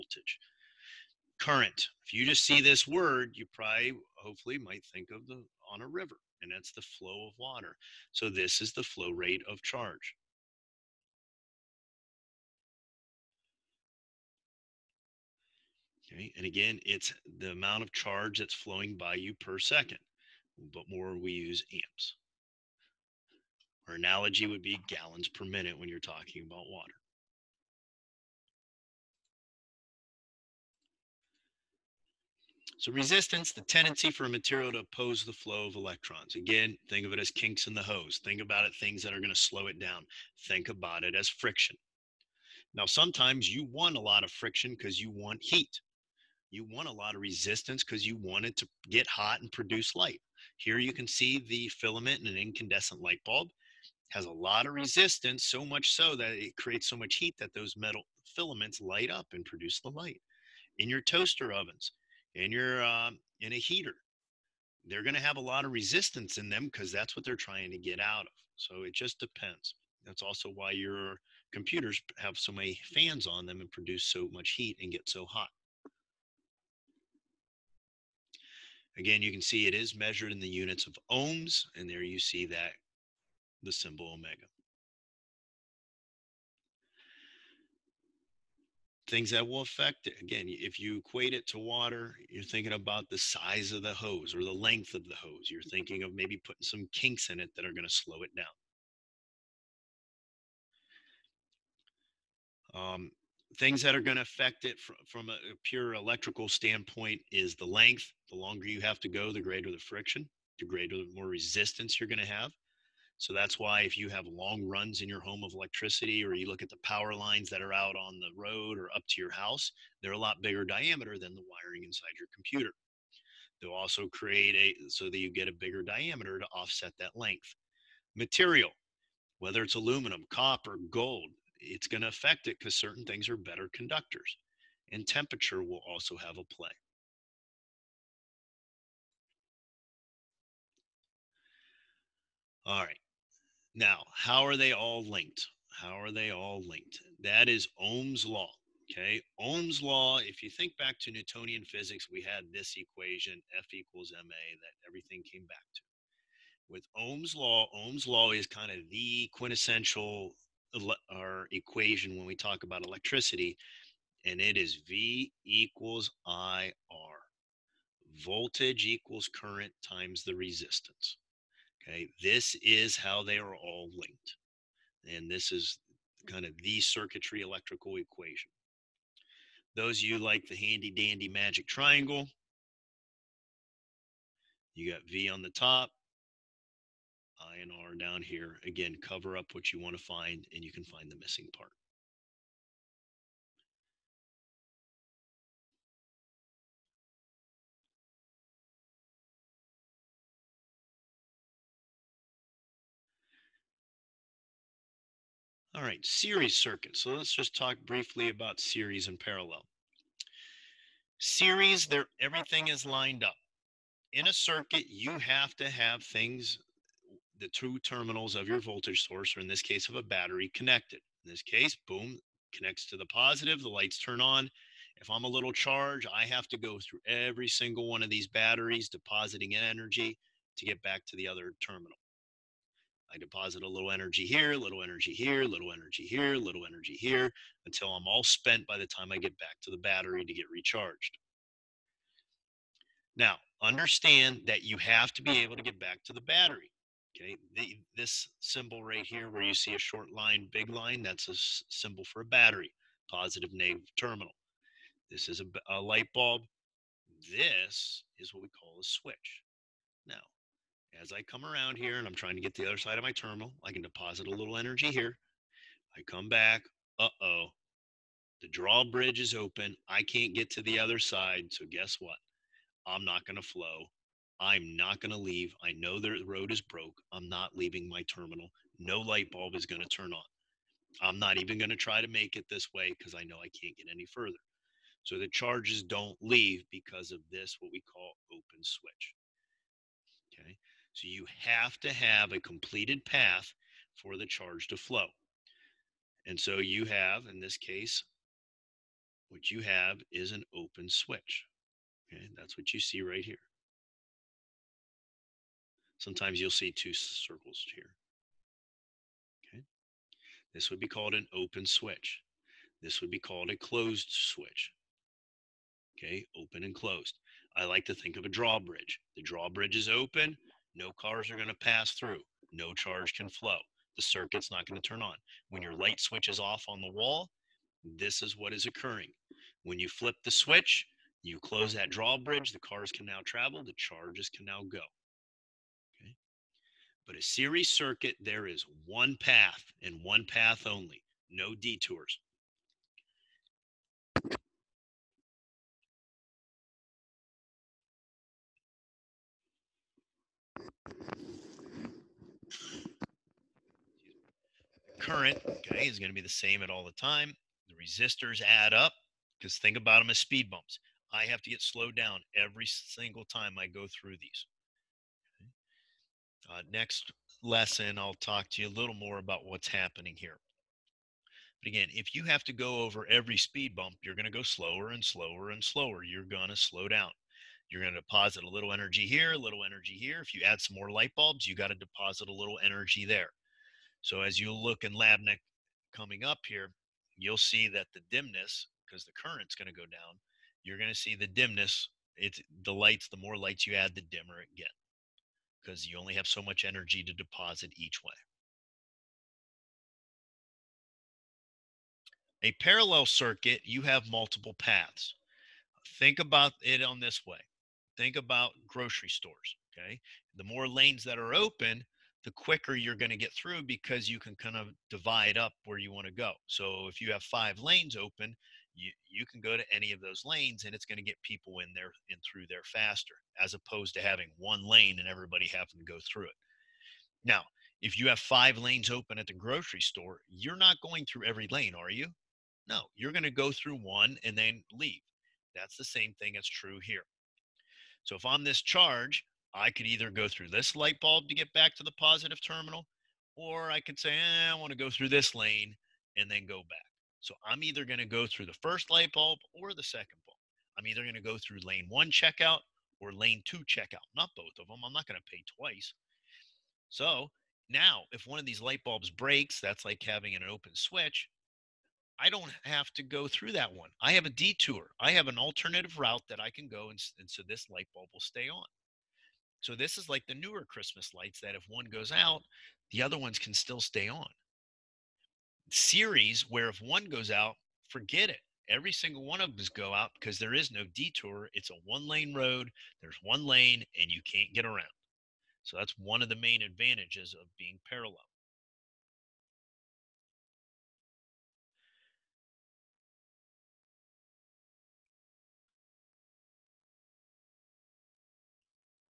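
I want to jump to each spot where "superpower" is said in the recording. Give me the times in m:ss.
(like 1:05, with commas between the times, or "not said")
not said.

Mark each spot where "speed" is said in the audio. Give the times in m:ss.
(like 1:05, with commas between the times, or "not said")
6:00, 6:13.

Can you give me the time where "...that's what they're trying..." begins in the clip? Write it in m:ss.
1:06.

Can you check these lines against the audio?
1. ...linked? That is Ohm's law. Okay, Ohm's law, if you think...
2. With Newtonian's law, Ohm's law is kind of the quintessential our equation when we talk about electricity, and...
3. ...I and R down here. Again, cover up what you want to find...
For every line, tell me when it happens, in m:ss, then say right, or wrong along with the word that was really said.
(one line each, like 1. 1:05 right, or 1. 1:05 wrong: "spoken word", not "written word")
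1. 2:26 right
2. 2:36 wrong: "Ohm", not "Newtonian"
3. 3:07 right.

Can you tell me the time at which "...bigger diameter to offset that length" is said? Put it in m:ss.
2:05.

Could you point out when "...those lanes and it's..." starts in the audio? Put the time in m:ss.
6:59.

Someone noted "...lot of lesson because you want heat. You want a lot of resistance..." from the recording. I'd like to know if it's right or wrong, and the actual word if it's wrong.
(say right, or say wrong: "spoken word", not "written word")
wrong: "friction", not "lesson".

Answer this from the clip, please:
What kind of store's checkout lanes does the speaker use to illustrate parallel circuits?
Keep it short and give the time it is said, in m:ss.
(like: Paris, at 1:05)
grocery stores, at 6:48.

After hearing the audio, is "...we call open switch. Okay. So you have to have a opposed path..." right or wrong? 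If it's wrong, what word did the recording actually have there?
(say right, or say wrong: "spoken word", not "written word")
wrong: "completed", not "opposed".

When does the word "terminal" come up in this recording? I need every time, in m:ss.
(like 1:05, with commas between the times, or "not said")
3:37, 3:51, 4:13, 4:23, 4:38, 7:22.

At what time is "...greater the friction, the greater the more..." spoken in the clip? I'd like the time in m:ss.
1:49.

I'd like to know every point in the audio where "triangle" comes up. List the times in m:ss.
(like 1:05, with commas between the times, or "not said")
3:01.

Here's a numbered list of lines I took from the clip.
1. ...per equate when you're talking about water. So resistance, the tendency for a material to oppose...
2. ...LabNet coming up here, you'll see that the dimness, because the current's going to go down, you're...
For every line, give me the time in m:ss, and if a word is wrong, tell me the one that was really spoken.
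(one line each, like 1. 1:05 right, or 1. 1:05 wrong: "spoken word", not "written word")
1. 0:25 wrong: "minute", not "equate"
2. 6:24 right.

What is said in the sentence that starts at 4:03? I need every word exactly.
Now, understand that you have to be able to get back to the battery.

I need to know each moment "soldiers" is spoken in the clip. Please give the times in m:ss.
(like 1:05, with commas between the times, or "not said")
not said.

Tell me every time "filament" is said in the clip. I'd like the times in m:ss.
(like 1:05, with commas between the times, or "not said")
0:51, 0:58.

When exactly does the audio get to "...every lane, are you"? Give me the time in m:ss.
7:11.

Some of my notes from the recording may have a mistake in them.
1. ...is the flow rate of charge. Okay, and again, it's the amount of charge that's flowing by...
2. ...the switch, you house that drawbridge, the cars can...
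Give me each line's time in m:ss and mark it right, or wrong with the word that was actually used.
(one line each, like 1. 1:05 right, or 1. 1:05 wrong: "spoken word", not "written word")
1. 0:08 right
2. 5:30 wrong: "close", not "house".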